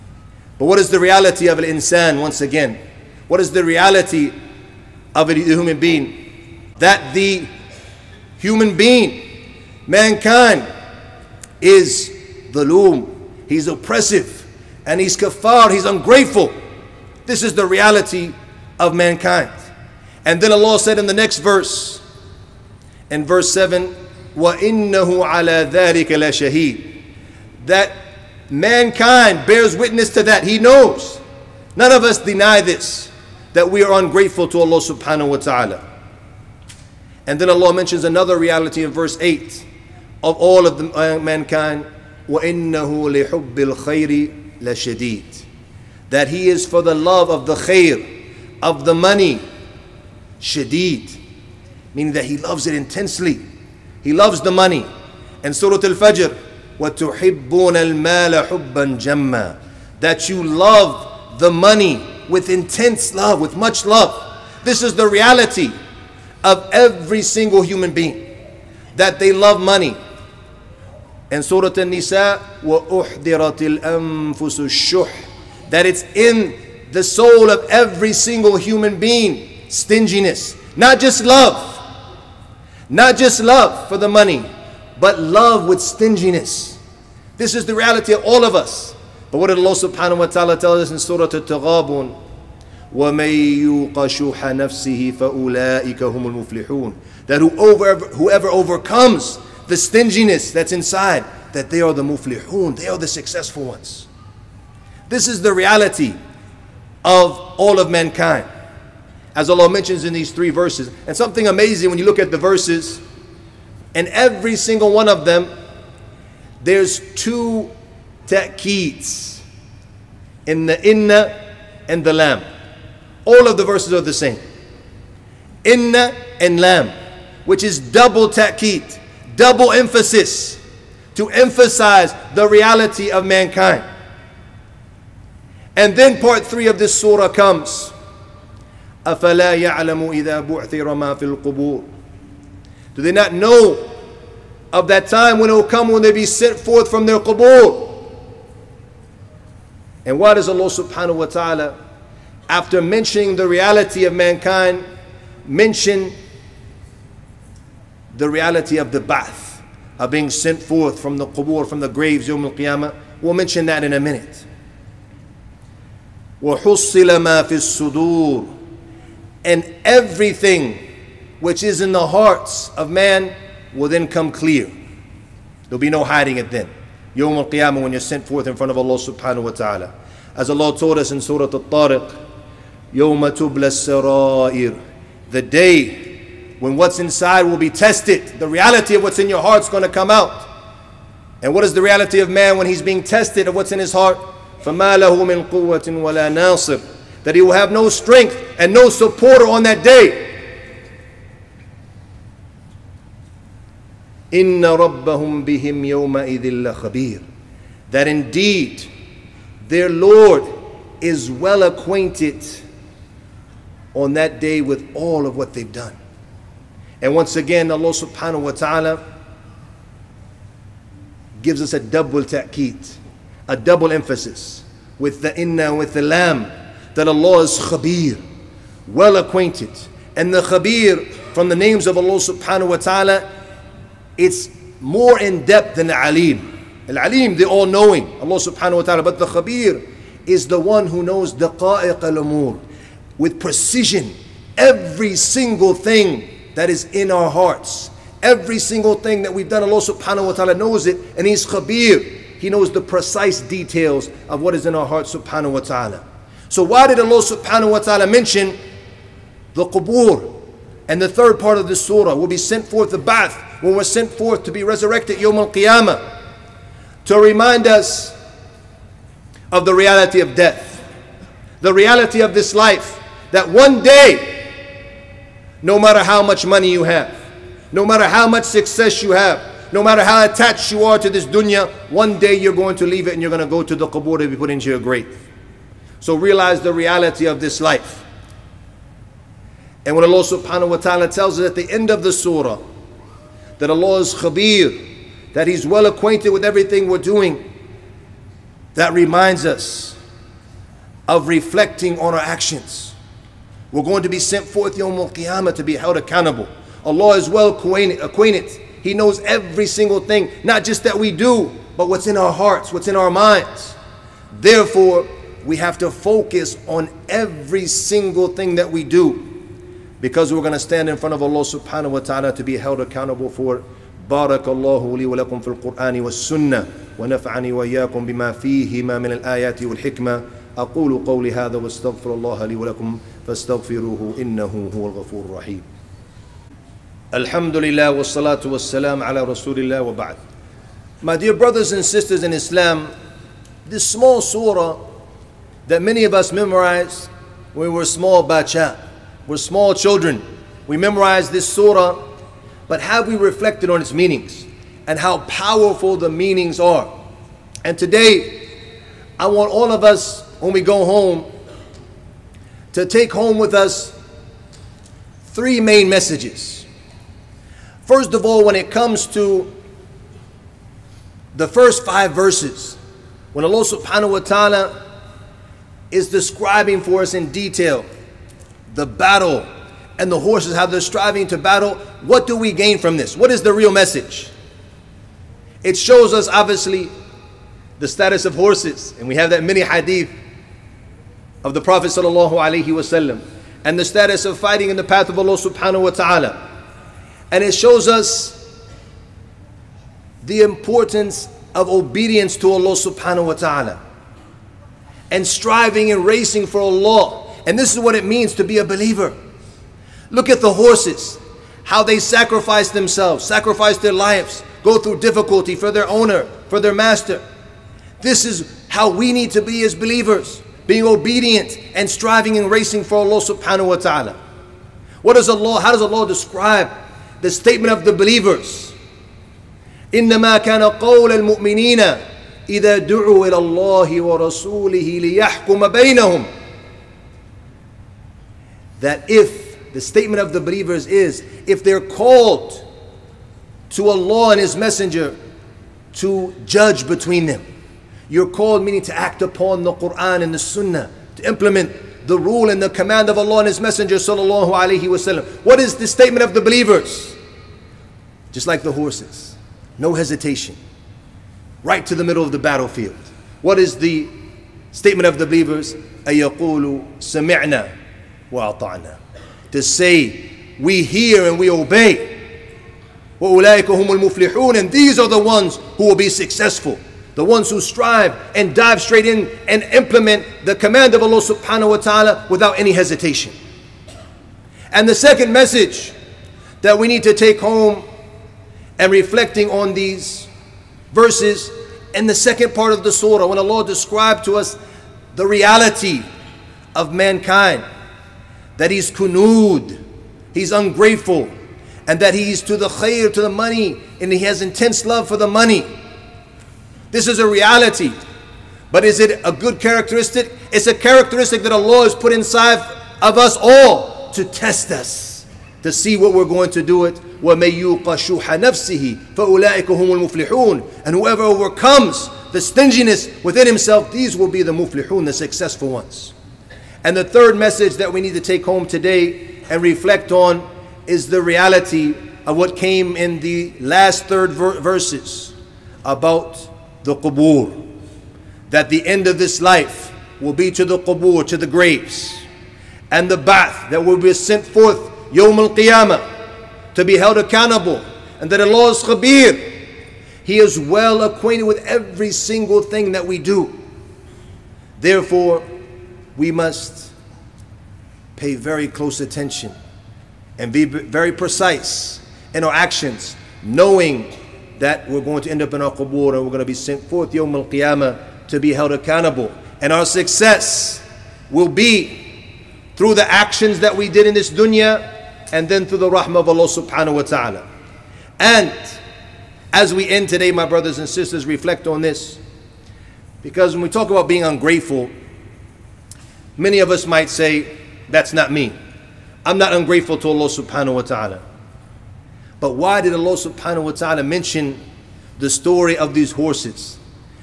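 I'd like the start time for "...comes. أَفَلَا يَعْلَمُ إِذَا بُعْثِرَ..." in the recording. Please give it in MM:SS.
02:17.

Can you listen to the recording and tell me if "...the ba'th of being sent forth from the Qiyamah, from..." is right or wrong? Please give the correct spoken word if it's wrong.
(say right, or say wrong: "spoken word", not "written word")
wrong: "Qubur", not "Qiyamah".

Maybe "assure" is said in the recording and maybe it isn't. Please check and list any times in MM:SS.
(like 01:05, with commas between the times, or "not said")
not said.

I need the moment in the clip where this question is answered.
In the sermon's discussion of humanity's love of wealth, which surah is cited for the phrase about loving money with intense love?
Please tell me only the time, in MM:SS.
00:55.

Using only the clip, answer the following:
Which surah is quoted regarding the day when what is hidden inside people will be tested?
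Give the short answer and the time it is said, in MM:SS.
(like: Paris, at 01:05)
Surah Al Tariq, at 03:01.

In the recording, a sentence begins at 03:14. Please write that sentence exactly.
فَمَا لَهُ مِنْ قُوَّةٍ وَلَا نَاصِرٍ That he will have no strength and no supporter on that day.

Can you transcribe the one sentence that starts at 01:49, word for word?
As Allah mentions in these three verses.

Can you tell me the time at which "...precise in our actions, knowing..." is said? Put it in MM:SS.
09:21.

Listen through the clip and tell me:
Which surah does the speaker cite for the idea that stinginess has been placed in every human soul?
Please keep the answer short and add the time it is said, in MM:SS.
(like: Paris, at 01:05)
Surah An-Nisa, at 01:11.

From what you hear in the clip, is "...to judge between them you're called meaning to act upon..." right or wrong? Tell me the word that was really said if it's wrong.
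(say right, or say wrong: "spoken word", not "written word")
right.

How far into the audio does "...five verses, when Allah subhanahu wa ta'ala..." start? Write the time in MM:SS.
06:11.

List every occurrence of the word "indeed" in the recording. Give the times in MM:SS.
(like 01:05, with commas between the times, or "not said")
03:28.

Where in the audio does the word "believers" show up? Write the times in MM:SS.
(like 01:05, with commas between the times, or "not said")
06:48, 06:59, 07:07, 07:20, 07:36, 07:45.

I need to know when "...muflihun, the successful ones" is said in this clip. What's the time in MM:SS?
08:44.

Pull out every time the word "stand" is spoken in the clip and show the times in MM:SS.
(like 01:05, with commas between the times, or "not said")
05:20.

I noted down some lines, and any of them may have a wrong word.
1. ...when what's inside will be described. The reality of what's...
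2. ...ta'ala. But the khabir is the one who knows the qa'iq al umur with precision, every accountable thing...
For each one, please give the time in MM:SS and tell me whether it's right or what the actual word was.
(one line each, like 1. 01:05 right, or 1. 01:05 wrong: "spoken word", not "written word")
1. 03:06 wrong: "tested", not "described"
2. 03:58 wrong: "single", not "accountable".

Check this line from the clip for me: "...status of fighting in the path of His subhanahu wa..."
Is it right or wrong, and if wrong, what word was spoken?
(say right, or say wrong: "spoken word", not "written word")
wrong: "Allah", not "His".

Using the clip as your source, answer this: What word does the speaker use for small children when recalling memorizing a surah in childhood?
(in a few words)
bacha.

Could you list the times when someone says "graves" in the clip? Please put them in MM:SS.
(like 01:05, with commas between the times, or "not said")
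02:41, 04:44, 09:01.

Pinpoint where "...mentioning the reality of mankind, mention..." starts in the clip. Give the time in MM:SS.
02:32.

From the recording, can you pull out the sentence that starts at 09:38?
And as we end today, my brothers and sisters, reflect on this.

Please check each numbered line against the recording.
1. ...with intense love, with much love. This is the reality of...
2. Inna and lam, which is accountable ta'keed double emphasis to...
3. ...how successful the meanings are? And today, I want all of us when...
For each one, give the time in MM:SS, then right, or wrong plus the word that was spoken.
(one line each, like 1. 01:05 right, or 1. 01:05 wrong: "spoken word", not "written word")
1. 01:02 right
2. 02:05 wrong: "double", not "accountable"
3. 05:54 wrong: "powerful", not "successful".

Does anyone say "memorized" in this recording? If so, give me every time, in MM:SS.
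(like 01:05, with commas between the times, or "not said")
05:46, 05:50.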